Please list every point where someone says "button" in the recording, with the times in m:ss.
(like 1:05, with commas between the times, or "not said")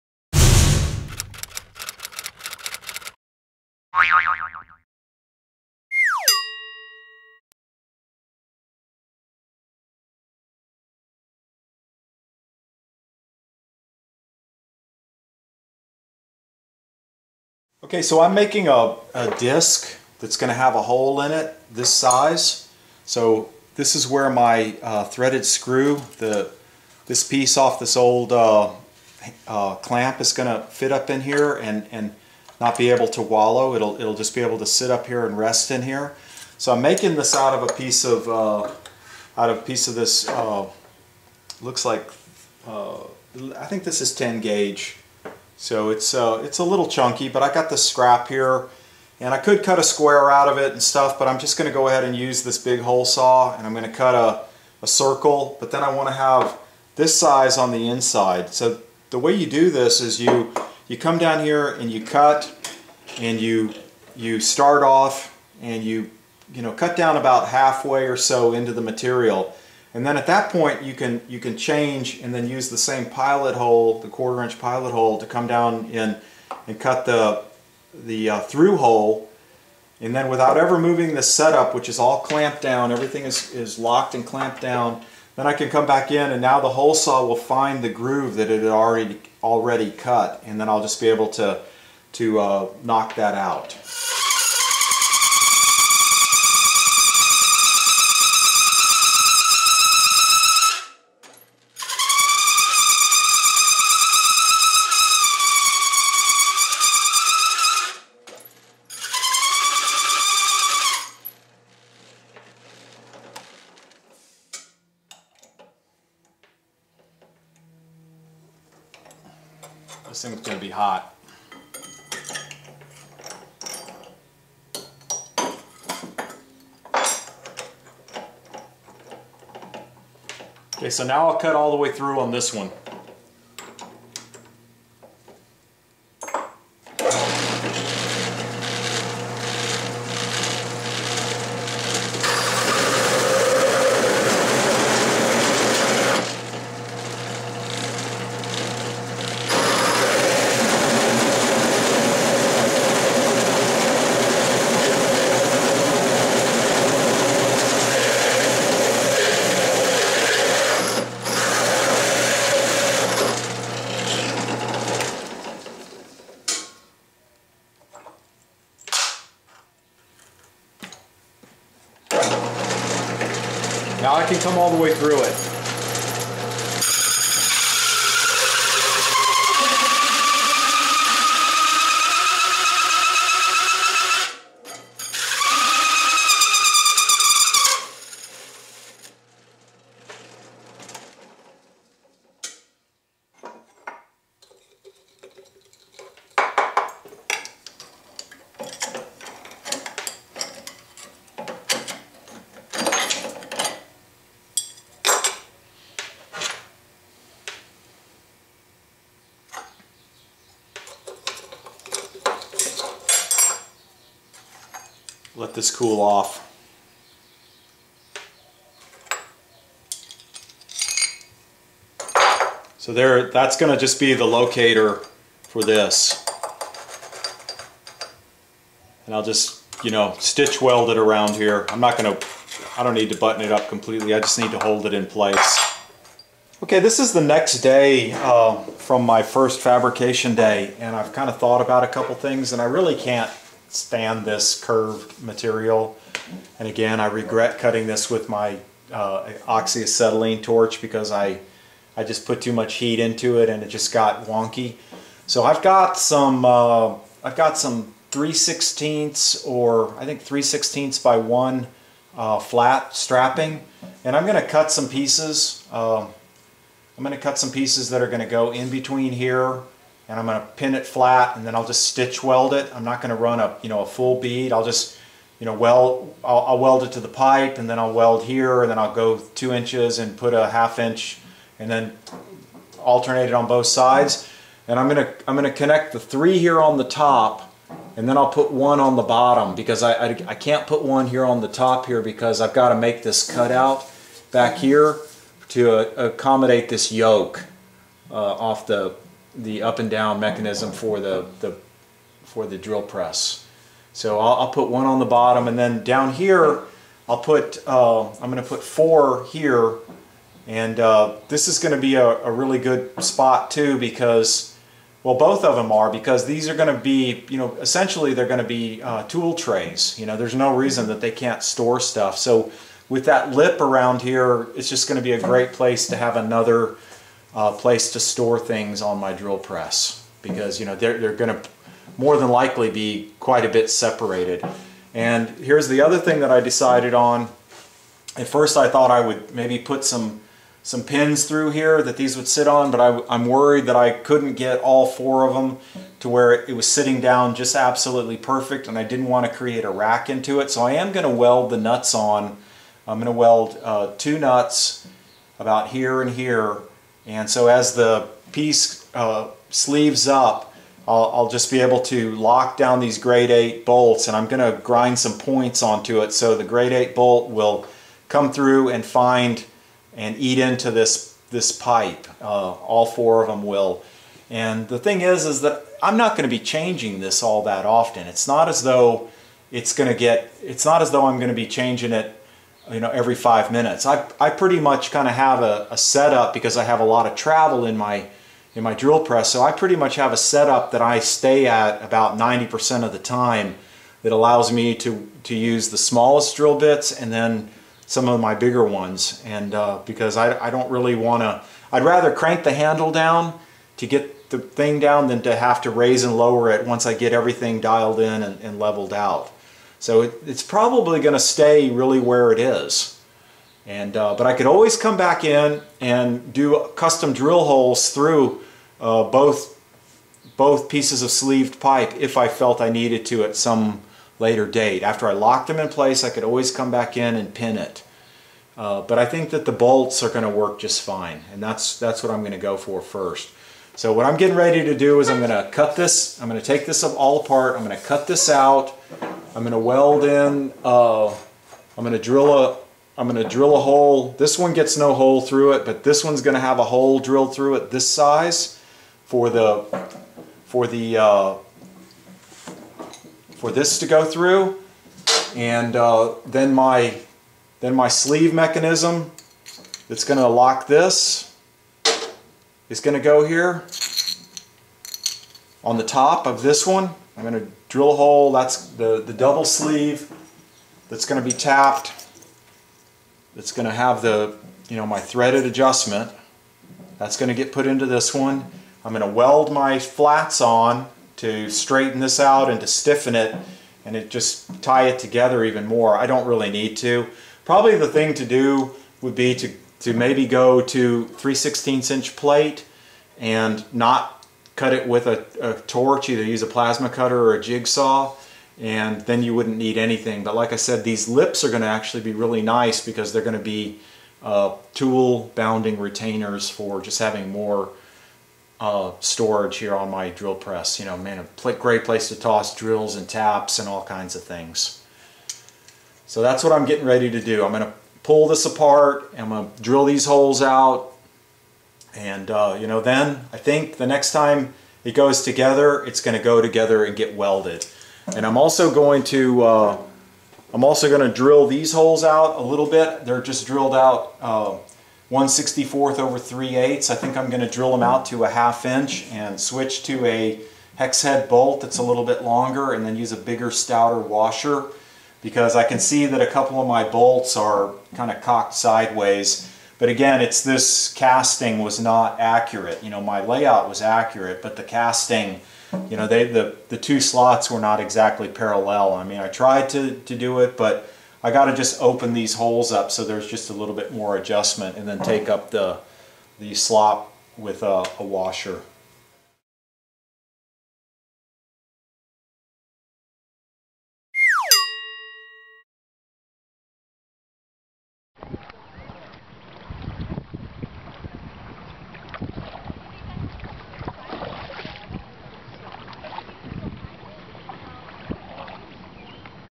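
3:53.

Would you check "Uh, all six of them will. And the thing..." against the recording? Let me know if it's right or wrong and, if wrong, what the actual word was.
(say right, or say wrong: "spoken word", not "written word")
wrong: "four", not "six".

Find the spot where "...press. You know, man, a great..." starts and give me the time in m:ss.
8:30.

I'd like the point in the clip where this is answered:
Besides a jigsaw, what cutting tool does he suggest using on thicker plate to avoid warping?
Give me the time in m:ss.
8:16.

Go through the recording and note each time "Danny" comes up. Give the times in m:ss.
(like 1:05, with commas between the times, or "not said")
not said.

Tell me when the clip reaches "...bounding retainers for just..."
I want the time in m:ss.
8:25.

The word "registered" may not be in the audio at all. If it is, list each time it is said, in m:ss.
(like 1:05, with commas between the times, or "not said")
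not said.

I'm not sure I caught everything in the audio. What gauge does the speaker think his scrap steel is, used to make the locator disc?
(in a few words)
10 gauge.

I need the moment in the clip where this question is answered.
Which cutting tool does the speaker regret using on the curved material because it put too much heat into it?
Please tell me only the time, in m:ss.
4:09.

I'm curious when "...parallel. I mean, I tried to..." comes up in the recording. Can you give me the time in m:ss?
9:18.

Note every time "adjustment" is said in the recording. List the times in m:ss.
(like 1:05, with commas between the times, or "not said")
7:55, 9:24.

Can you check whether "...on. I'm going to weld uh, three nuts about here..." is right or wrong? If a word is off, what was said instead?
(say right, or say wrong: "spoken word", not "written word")
wrong: "two", not "three".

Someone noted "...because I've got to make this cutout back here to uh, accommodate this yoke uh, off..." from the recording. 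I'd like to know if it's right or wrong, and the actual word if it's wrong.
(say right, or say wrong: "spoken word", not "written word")
right.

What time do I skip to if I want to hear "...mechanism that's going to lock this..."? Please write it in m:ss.
7:38.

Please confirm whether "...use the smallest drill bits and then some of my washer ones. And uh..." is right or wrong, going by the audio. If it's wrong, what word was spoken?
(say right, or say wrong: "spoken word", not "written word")
wrong: "bigger", not "washer".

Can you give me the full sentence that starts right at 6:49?
So it, it's probably going to stay really where it is.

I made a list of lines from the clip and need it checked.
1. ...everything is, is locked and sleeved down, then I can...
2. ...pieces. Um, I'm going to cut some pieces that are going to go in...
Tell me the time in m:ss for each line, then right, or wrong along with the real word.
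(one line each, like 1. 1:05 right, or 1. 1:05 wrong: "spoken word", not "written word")
1. 1:22 wrong: "clamped", not "sleeved"
2. 4:24 right.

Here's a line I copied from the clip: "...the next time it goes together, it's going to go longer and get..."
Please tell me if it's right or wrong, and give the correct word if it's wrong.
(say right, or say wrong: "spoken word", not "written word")
wrong: "together", not "longer".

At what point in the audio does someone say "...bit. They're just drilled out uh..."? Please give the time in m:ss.
8:52.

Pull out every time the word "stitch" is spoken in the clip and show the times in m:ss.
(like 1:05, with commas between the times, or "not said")
3:50, 4:31.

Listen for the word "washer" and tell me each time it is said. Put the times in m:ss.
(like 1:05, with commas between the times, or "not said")
9:03, 9:28.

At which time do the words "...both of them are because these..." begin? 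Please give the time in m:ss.
5:15.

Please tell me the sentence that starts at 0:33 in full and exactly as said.
It'll, it'll just be able to sit up here and rest in here.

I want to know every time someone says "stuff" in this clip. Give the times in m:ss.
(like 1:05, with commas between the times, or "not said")
0:50, 5:21.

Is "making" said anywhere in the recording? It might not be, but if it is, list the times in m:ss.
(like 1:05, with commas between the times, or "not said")
0:18, 0:36.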